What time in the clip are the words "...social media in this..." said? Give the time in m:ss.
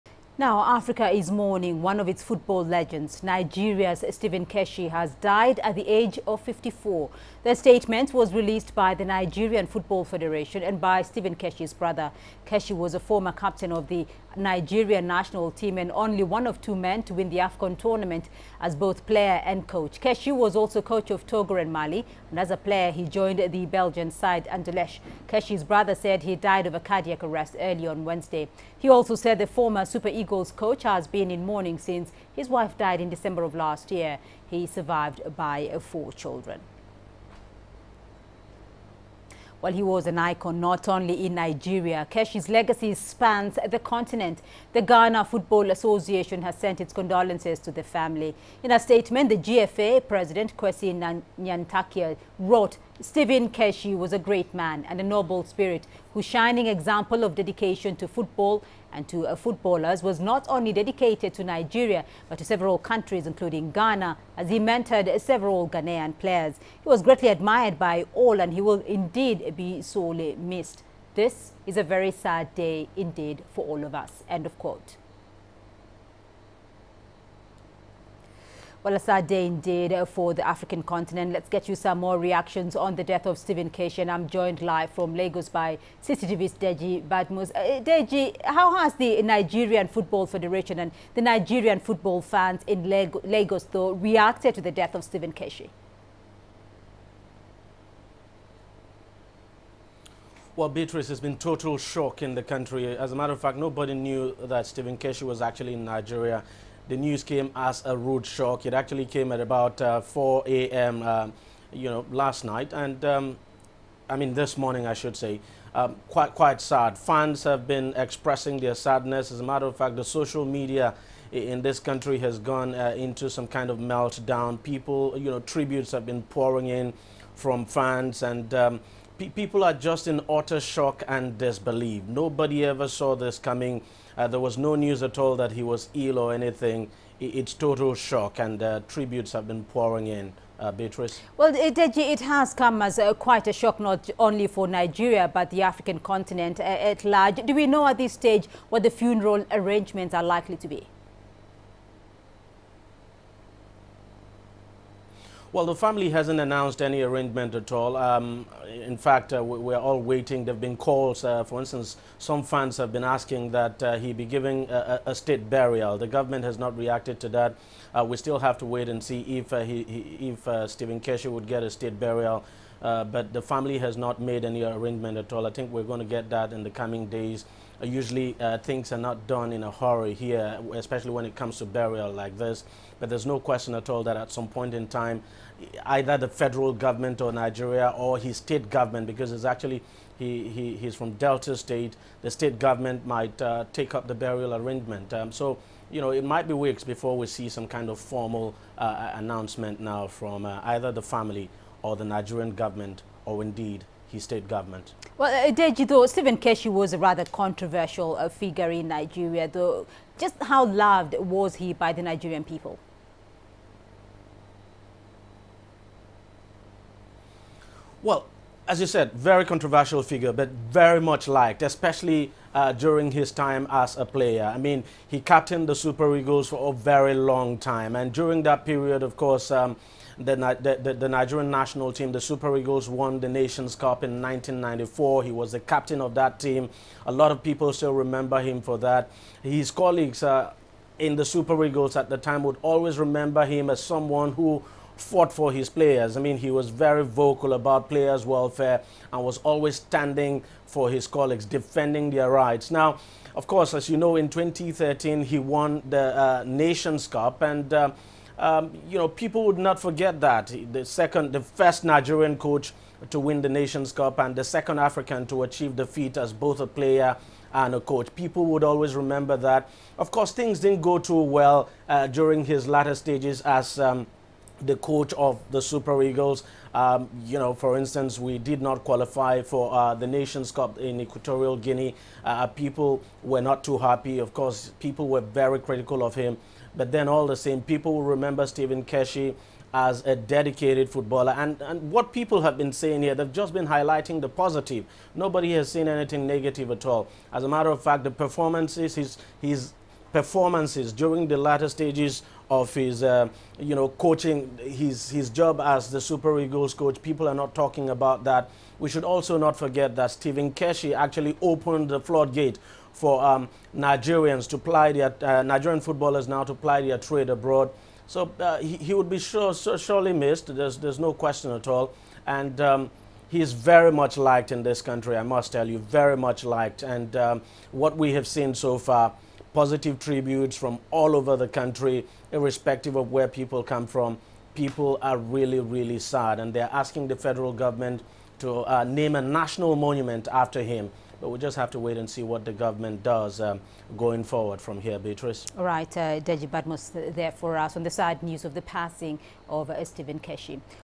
2:00.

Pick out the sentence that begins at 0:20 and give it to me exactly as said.
Keshi was also coach of Togo and Mali, and as a player, he joined the Belgian side Anderlecht.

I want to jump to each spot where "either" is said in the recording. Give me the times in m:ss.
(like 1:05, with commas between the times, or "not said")
3:05, 3:20.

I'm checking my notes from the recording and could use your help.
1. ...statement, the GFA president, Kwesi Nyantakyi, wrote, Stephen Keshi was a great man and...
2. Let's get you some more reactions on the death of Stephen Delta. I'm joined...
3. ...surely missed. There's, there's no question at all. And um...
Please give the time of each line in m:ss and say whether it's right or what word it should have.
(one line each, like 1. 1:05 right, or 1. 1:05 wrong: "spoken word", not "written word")
1. 0:48 right
2. 1:21 wrong: "Keshi", not "Delta"
3. 5:19 right.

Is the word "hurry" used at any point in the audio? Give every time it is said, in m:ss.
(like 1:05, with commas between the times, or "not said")
2:59.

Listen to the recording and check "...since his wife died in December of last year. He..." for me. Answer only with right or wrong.
right.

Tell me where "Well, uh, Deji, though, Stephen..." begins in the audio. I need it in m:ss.
3:25.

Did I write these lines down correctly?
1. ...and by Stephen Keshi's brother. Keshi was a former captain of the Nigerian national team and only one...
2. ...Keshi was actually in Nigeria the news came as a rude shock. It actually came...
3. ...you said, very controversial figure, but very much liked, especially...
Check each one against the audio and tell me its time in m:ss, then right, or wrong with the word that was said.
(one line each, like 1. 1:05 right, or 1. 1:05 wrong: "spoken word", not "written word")
1. 0:10 right
2. 1:44 right
3. 3:38 right.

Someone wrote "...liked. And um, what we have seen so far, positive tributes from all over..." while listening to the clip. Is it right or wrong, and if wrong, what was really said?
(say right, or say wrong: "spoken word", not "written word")
right.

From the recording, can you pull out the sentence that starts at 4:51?
And, and what people have been saying here, they've just been highlighting the positive.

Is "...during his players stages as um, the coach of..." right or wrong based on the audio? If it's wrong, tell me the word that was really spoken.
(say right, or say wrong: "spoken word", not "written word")
wrong: "latter", not "players".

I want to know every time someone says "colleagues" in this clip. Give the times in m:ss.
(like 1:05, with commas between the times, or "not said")
3:59, 4:11.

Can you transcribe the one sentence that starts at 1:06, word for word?
He was greatly admired by all and he will indeed be sorely missed.